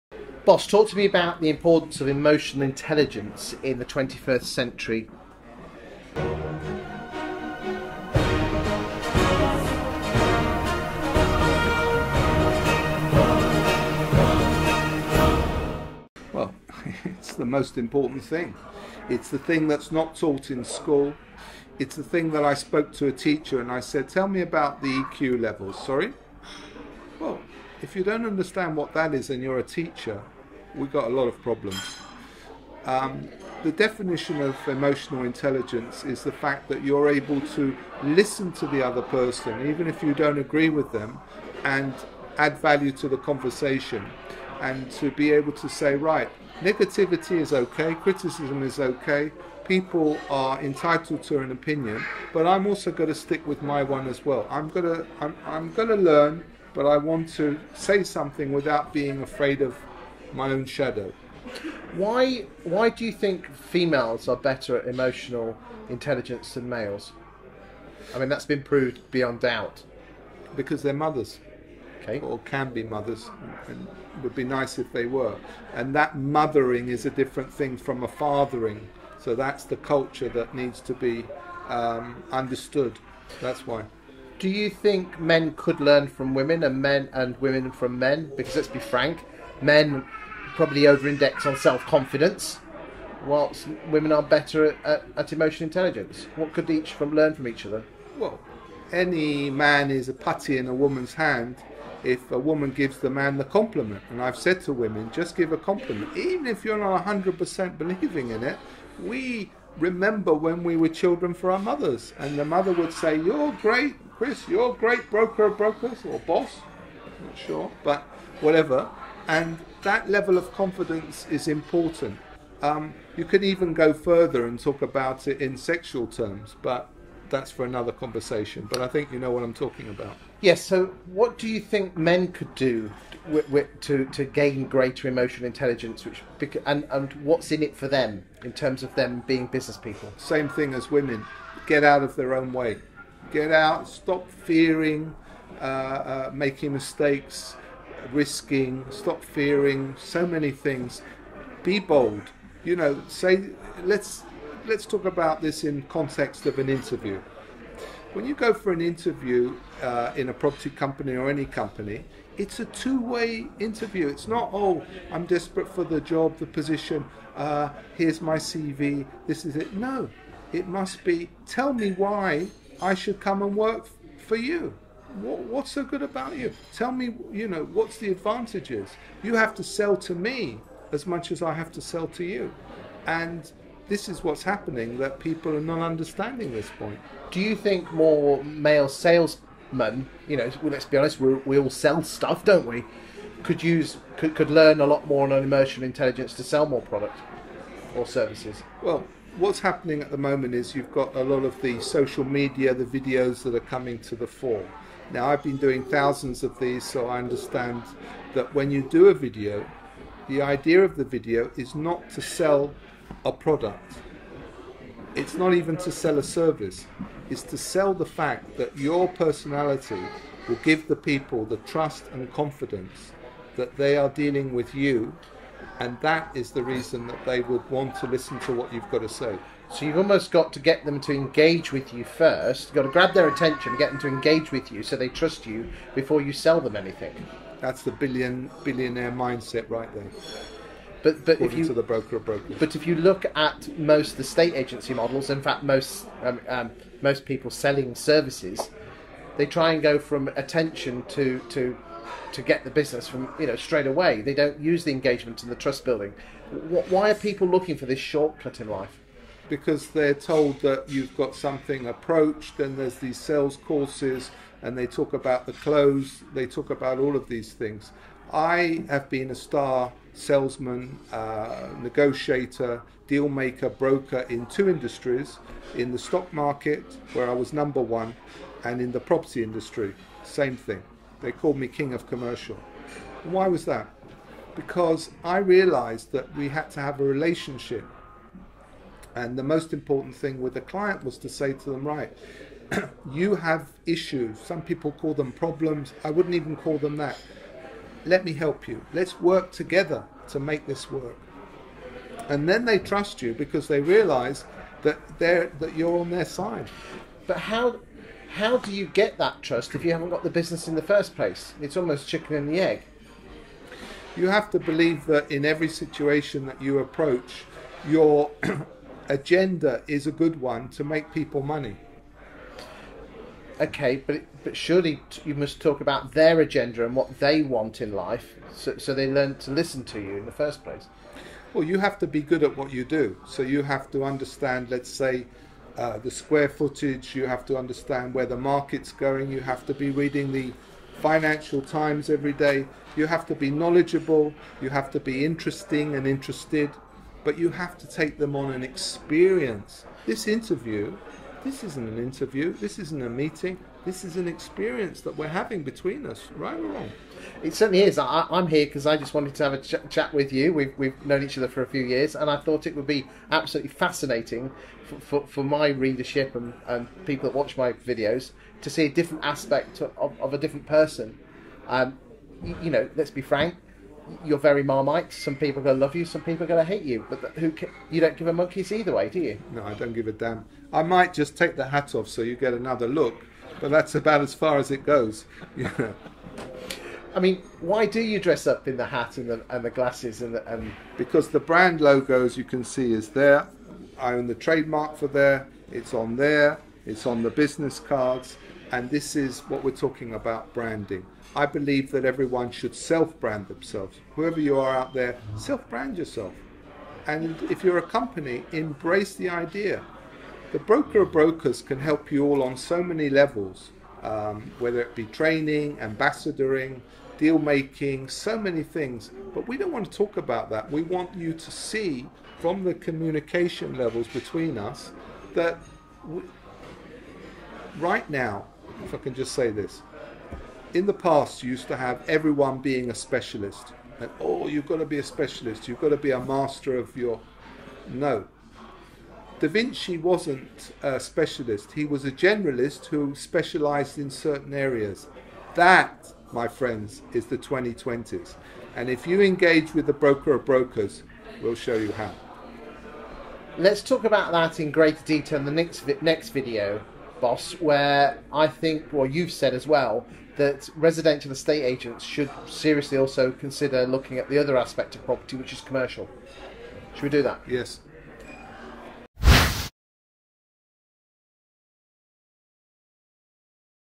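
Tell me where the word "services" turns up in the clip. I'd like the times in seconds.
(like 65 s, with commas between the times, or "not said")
198 s, 216 s, 247 s.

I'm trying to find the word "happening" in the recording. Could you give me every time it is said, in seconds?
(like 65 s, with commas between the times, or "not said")
184 s, 199 s.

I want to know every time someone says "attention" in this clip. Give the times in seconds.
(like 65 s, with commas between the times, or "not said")
233 s, 250 s.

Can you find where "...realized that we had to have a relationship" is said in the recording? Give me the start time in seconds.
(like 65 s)
285 s.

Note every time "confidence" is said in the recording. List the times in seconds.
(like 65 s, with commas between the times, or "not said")
91 s, 120 s, 222 s.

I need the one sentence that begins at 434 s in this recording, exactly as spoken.
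and oh, you've got to be a specialist, you've got to be a master of your.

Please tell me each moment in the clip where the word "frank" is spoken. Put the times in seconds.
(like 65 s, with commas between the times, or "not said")
88 s, 373 s.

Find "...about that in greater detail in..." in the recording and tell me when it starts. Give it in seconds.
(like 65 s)
454 s.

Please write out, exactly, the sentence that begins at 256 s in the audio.
Why are people looking for this shortcut in life?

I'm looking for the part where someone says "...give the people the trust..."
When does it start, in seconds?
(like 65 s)
220 s.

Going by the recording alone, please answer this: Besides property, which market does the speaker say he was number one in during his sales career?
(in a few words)
stock market.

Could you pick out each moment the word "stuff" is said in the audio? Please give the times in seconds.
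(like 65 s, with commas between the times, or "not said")
192 s.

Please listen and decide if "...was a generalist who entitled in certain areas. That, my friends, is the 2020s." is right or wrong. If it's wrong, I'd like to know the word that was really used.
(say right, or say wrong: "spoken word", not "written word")
wrong: "specialized", not "entitled".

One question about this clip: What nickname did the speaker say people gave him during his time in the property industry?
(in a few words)
king of commercial.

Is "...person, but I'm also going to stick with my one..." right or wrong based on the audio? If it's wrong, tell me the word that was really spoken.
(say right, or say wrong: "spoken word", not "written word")
wrong: "opinion", not "person".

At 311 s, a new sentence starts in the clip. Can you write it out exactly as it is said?
It's almost chicken and the egg.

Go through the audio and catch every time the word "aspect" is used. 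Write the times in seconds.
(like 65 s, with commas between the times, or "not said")
369 s, 464 s.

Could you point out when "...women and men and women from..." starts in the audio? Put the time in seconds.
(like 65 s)
86 s.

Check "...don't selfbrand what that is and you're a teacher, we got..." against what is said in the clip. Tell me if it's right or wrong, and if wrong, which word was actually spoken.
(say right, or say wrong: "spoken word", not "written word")
wrong: "understand", not "selfbrand".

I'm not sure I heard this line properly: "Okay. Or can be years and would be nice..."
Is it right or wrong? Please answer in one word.
wrong.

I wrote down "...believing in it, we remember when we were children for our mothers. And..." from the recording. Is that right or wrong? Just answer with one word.
right.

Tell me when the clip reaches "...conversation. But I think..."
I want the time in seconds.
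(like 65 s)
127 s.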